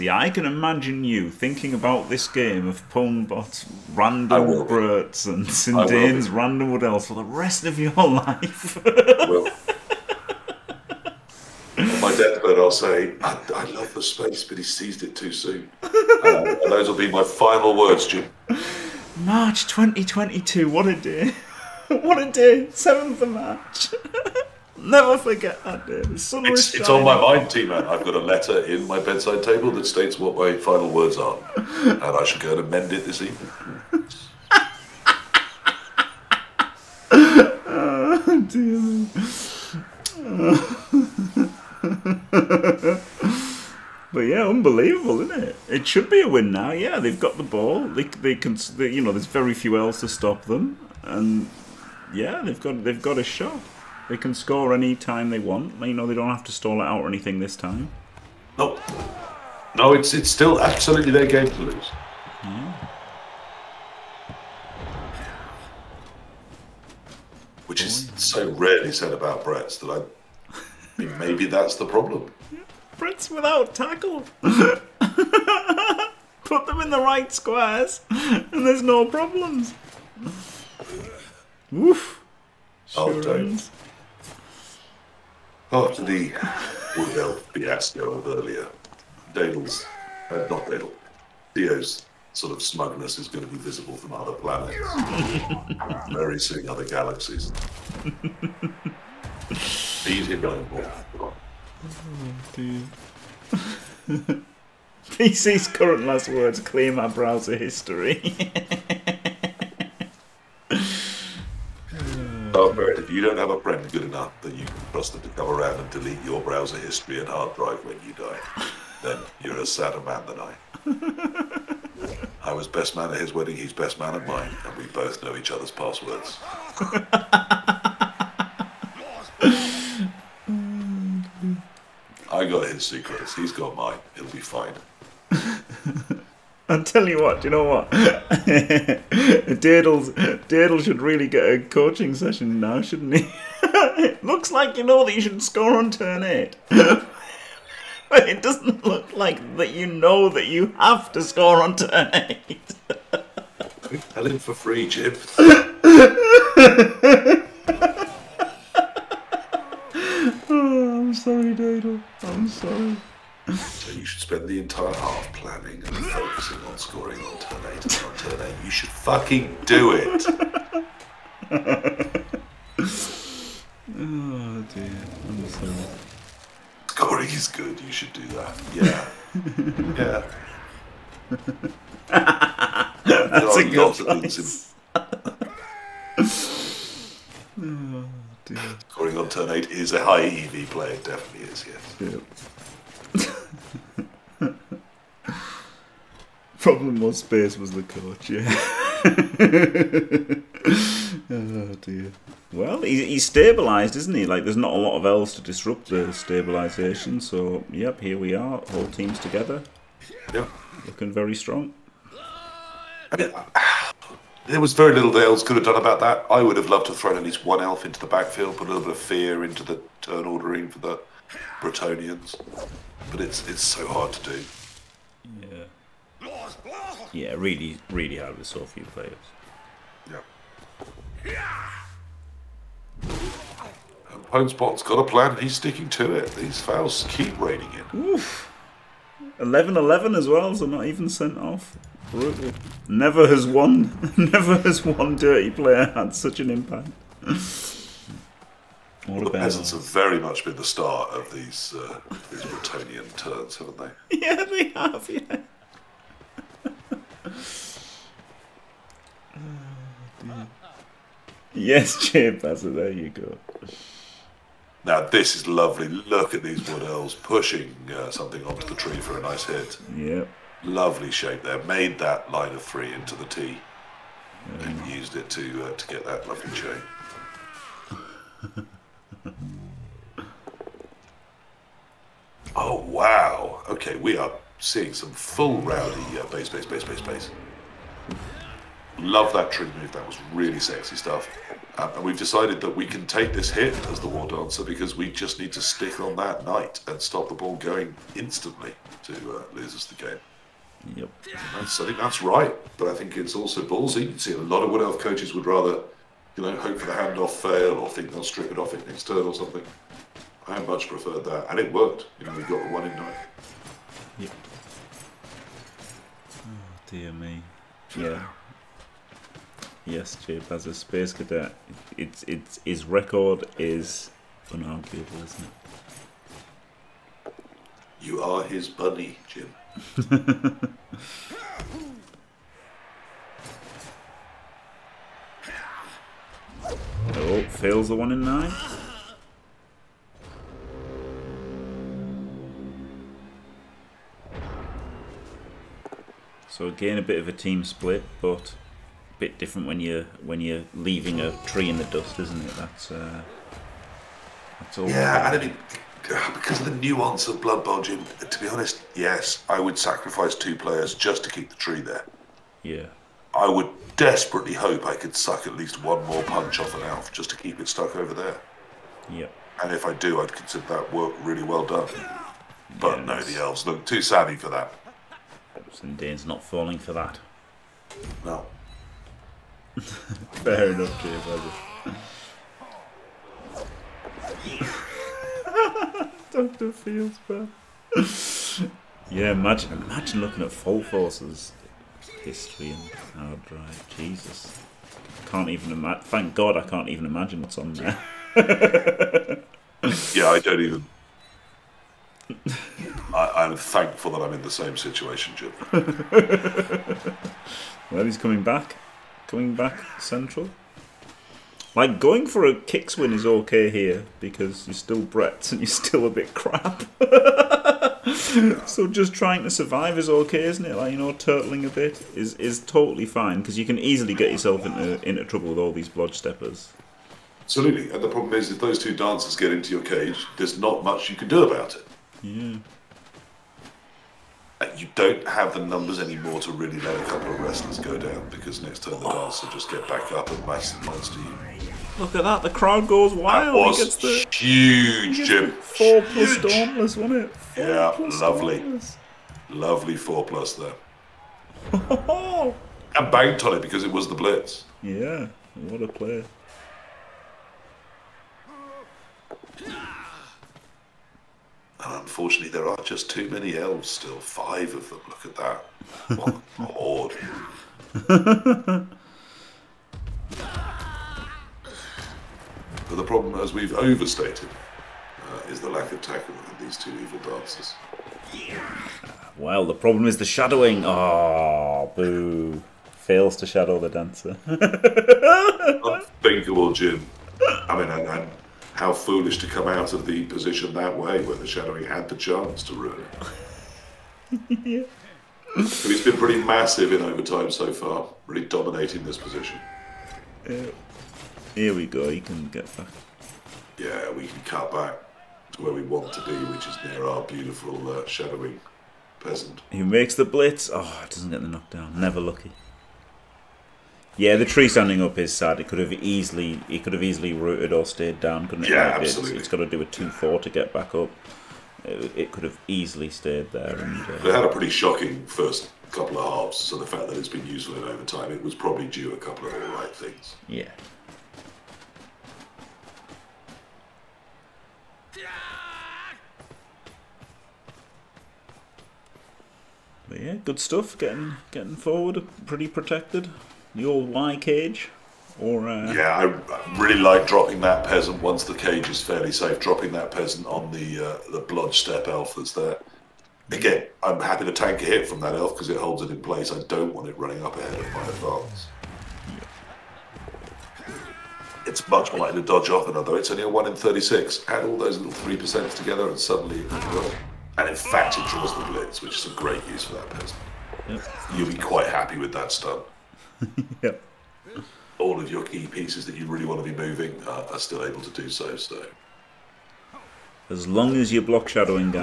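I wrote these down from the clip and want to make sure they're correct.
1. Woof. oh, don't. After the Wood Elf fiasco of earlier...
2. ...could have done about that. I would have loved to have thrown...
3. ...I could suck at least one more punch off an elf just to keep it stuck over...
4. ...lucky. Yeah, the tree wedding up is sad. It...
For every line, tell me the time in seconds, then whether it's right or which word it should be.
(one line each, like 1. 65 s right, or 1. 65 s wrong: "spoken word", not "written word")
1. 81 s right
2. 215 s right
3. 364 s right
4. 512 s wrong: "standing", not "wedding".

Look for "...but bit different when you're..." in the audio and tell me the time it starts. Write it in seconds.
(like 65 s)
348 s.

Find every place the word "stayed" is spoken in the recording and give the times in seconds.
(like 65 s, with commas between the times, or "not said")
517 s, 523 s.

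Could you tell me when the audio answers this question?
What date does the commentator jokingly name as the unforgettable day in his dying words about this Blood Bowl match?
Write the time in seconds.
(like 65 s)
22 s.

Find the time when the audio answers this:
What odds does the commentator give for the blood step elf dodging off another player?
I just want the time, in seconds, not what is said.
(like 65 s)
563 s.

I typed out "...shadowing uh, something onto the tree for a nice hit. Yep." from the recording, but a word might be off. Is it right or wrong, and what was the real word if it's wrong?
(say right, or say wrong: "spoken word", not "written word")
wrong: "pushing", not "shadowing".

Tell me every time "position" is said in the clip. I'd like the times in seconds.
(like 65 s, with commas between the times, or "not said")
490 s, 499 s.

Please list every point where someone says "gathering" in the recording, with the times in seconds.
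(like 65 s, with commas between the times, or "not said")
not said.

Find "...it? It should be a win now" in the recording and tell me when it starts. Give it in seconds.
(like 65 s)
45 s.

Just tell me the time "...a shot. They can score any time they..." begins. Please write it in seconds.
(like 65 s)
53 s.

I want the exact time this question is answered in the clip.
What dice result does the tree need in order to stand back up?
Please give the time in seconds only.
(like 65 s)
519 s.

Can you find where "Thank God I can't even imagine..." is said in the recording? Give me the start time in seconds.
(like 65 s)
396 s.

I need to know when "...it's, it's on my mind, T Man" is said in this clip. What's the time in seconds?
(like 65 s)
26 s.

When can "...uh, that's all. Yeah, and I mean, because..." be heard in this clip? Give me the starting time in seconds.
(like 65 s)
352 s.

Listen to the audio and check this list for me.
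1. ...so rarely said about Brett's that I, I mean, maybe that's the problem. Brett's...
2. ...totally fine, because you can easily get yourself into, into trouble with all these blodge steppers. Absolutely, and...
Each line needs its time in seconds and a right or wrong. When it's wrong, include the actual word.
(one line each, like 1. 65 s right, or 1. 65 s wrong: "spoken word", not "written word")
1. 68 s right
2. 422 s right.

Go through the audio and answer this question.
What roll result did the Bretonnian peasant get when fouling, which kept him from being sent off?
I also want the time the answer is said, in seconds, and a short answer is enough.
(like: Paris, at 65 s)
11-11, at 239 s.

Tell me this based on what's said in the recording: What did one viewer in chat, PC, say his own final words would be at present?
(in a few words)
clear my browser history.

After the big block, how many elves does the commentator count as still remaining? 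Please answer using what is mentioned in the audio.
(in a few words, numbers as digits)
Five.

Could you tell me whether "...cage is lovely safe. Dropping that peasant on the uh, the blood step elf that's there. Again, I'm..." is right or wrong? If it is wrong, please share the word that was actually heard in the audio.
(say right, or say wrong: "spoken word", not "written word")
wrong: "fairly", not "lovely".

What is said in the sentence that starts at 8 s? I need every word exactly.
well, on my deathbed, I'll say, I, I, love the space, but he seized it too soon.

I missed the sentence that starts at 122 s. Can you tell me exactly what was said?
I was best man at his wedding, he's best man at mine, and we both know each other's passwords.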